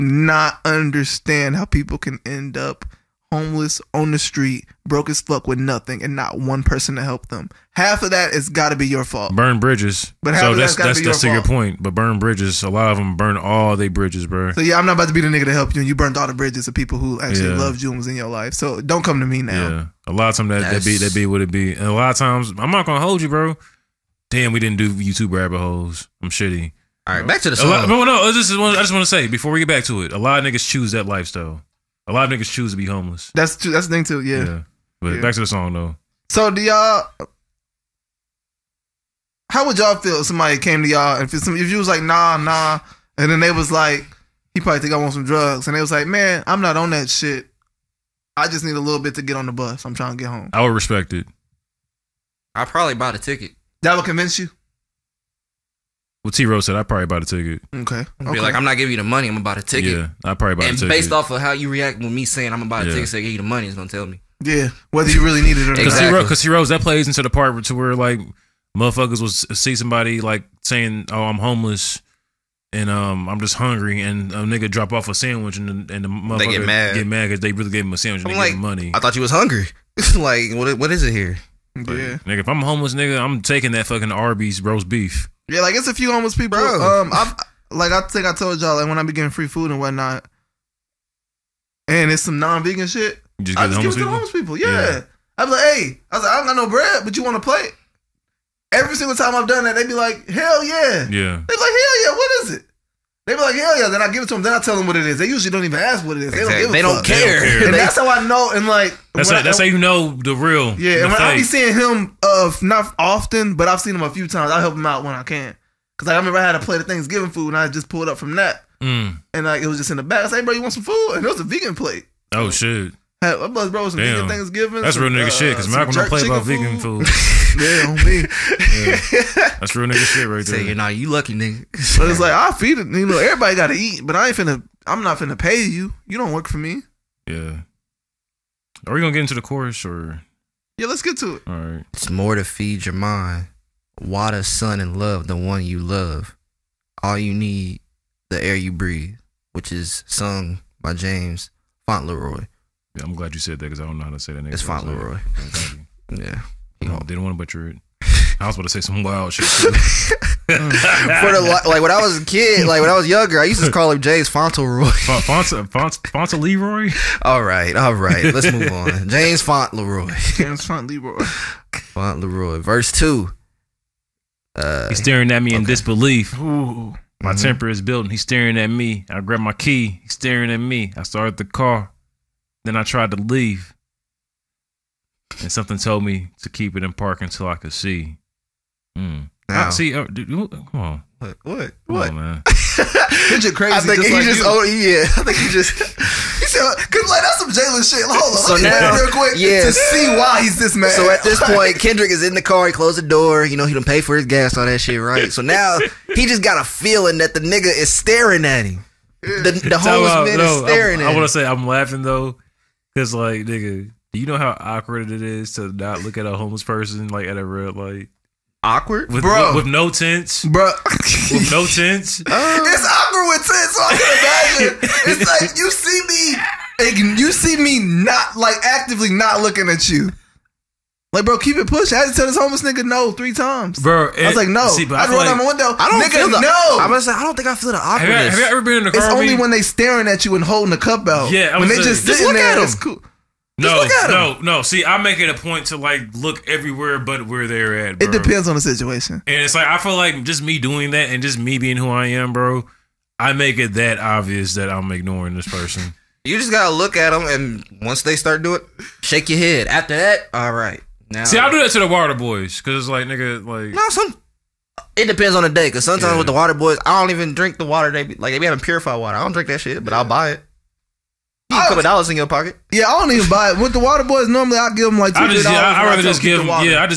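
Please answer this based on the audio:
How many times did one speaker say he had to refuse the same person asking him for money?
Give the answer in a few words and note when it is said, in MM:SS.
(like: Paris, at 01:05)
3 times, at 03:53.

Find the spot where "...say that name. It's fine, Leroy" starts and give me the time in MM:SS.
02:34.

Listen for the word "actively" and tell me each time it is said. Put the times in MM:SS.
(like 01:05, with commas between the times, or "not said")
03:48.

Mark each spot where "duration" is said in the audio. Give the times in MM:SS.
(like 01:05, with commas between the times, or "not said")
not said.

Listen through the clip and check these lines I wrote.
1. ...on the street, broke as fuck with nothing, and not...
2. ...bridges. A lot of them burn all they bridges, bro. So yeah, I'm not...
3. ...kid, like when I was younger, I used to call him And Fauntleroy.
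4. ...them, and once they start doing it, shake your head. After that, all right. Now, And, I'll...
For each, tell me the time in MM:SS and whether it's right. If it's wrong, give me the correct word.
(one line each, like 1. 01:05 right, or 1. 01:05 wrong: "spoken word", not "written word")
1. 00:03 right
2. 00:12 right
3. 02:42 wrong: "James", not "And"
4. 04:17 wrong: "See", not "And".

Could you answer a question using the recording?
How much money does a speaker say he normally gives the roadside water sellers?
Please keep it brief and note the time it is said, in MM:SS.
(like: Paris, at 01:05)
$2, at 04:35.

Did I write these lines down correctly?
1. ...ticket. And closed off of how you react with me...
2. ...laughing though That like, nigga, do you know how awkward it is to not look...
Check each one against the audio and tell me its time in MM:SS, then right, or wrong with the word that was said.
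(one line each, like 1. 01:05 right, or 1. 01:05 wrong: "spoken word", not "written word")
1. 01:00 wrong: "based", not "closed"
2. 03:31 wrong: "Cause", not "That".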